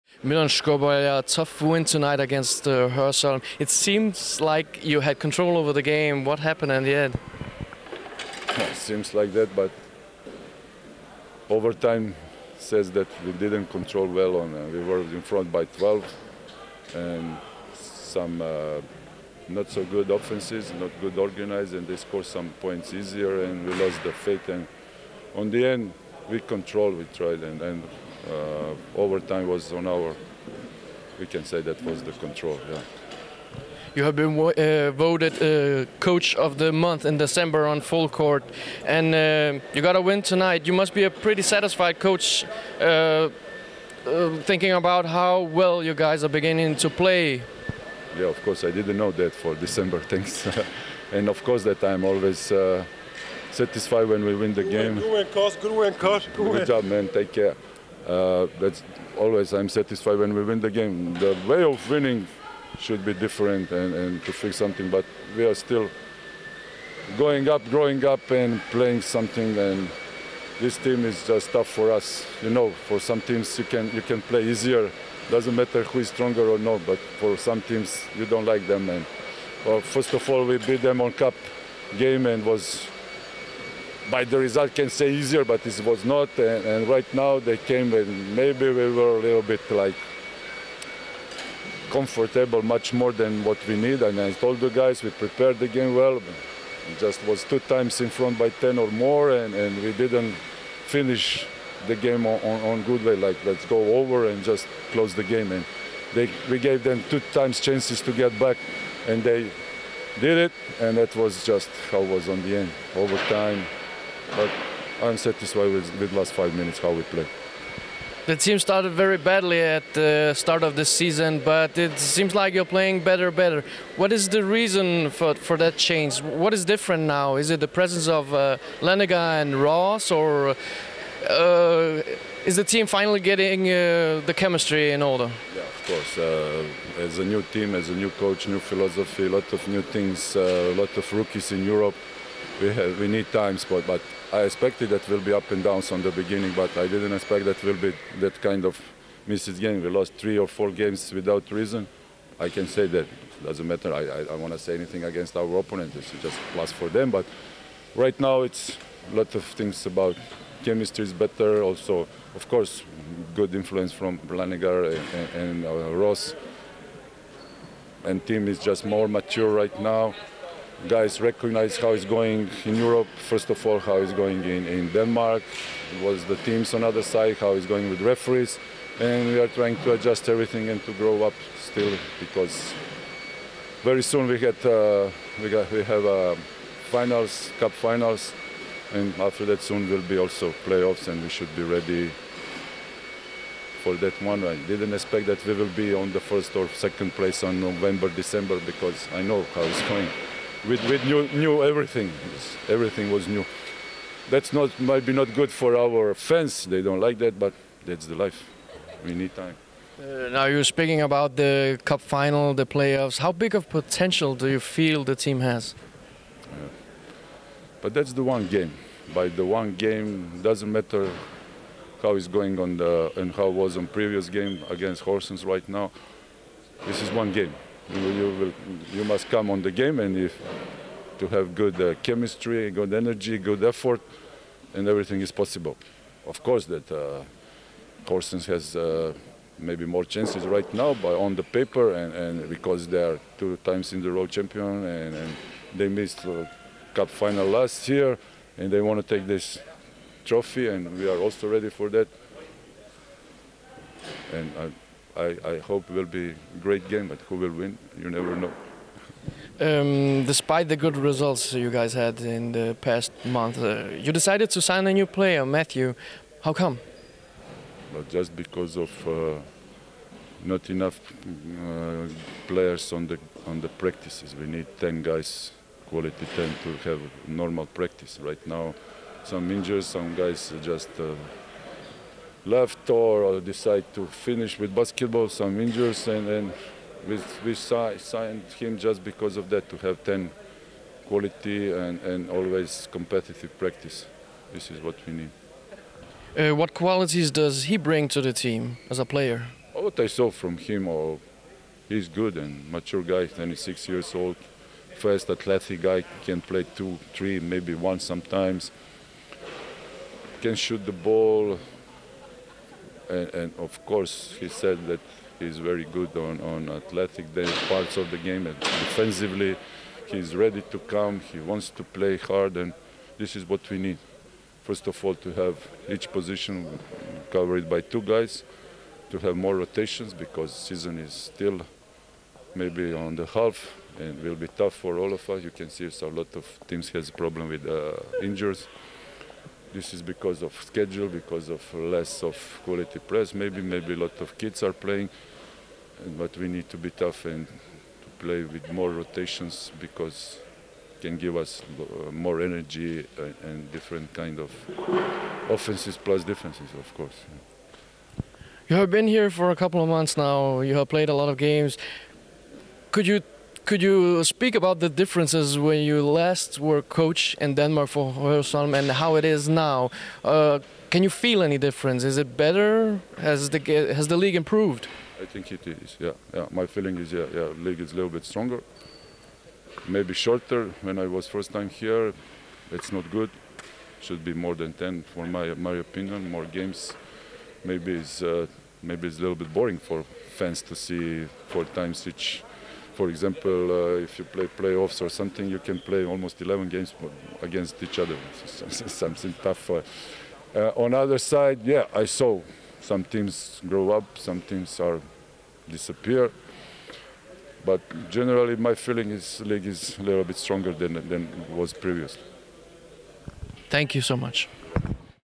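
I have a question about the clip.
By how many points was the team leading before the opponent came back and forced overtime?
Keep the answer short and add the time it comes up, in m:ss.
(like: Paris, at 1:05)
12, at 0:15.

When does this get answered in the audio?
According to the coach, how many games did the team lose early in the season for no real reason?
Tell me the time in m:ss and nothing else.
2:30.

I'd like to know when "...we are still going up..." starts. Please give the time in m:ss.
1:05.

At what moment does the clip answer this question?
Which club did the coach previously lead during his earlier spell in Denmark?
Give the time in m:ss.
6:08.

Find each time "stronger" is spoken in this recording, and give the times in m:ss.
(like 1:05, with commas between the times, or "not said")
1:16, 6:18, 6:50.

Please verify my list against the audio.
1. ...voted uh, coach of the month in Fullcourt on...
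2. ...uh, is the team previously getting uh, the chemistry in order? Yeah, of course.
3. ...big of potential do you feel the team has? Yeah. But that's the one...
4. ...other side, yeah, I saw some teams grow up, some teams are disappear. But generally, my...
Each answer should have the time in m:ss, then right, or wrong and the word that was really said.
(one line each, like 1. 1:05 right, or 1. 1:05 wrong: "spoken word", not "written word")
1. 0:34 wrong: "December", not "Fullcourt"
2. 2:11 wrong: "finally", not "previously"
3. 3:33 right
4. 6:40 right.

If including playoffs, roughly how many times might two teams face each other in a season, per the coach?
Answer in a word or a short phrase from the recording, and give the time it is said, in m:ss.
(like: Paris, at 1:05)
11, at 6:36.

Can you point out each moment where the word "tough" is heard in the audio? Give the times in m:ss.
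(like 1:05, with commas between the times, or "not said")
0:01, 1:11, 5:34, 5:46, 6:39.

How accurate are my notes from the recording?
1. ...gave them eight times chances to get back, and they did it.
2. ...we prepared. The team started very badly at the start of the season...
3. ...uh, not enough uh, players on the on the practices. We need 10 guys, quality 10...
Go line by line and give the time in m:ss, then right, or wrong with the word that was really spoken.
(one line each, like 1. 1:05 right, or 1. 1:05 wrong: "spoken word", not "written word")
1. 1:46 wrong: "two", not "eight"
2. 1:56 wrong: "played", not "prepared"
3. 4:29 right.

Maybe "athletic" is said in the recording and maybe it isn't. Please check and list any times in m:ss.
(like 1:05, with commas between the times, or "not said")
5:05, 5:16.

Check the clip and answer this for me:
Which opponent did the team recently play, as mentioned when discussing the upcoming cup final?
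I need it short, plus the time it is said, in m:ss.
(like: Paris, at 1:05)
Horsens, at 3:45.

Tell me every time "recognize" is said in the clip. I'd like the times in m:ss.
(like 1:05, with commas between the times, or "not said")
2:51.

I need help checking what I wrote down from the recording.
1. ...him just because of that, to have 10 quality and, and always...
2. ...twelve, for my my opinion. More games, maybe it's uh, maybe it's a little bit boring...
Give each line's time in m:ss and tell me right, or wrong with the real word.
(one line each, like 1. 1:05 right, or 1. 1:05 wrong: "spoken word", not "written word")
1. 4:48 right
2. 6:24 wrong: "ten", not "twelve".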